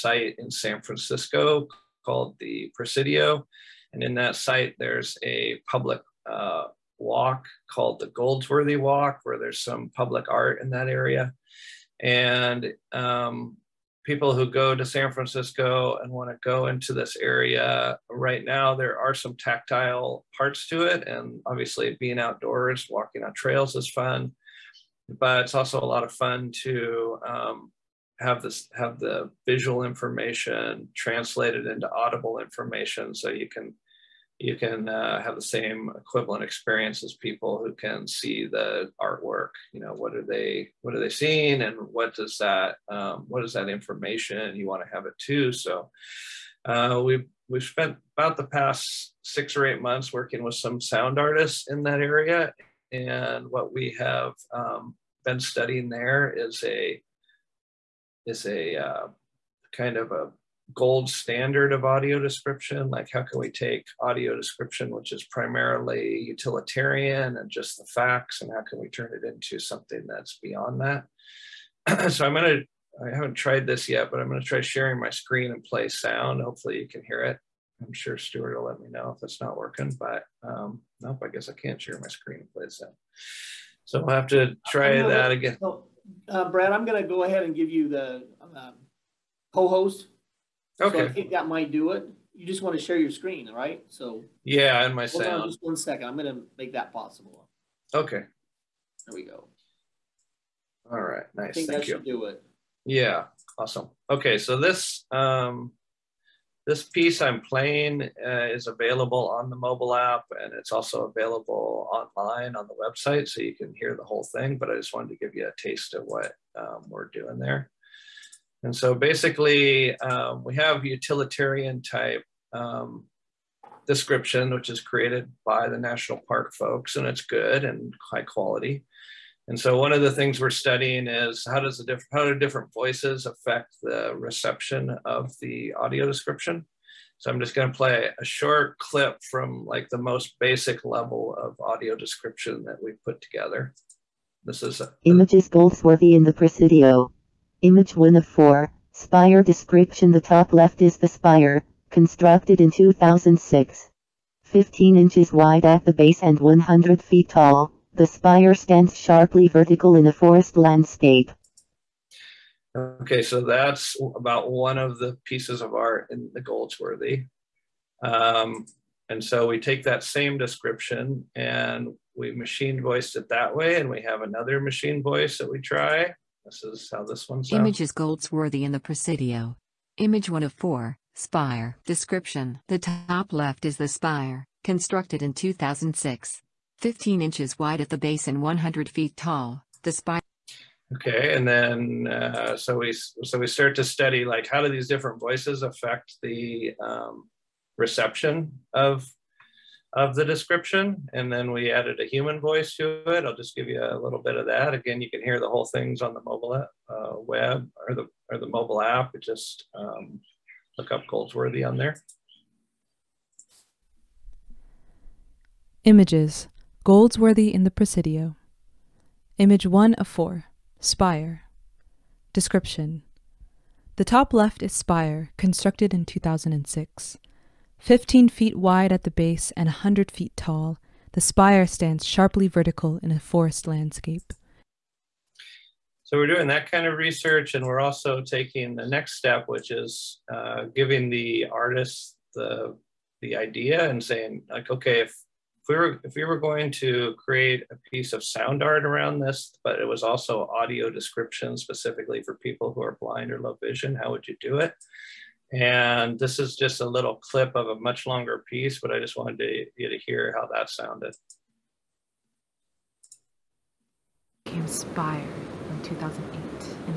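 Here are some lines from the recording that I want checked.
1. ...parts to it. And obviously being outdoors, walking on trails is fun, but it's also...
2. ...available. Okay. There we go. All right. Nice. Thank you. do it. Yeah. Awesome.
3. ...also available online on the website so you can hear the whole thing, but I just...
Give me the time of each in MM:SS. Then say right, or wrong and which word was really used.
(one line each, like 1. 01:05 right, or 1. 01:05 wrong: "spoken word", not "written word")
1. 00:20 right
2. 01:36 wrong: "possible", not "available"
3. 01:50 right.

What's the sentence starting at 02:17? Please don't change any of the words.
So I'm just gonna play a short clip from like the most basic level of audio description that we put together.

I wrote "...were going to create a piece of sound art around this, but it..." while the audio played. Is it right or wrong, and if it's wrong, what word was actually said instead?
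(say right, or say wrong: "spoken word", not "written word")
right.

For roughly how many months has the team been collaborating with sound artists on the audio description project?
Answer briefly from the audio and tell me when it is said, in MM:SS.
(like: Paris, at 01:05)
6 or 8 months, at 00:49.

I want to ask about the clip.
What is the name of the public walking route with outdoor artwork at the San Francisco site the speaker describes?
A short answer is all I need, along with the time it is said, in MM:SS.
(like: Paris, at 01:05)
Goldsworthy Walk, at 00:08.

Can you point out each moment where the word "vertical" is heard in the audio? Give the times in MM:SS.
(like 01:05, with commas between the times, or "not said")
02:39, 03:52.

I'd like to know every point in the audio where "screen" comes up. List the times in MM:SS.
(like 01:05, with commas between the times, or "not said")
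01:15, 01:22, 01:33.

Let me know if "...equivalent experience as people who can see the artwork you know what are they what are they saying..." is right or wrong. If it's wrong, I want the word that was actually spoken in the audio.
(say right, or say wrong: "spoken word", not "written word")
wrong: "seeing", not "saying".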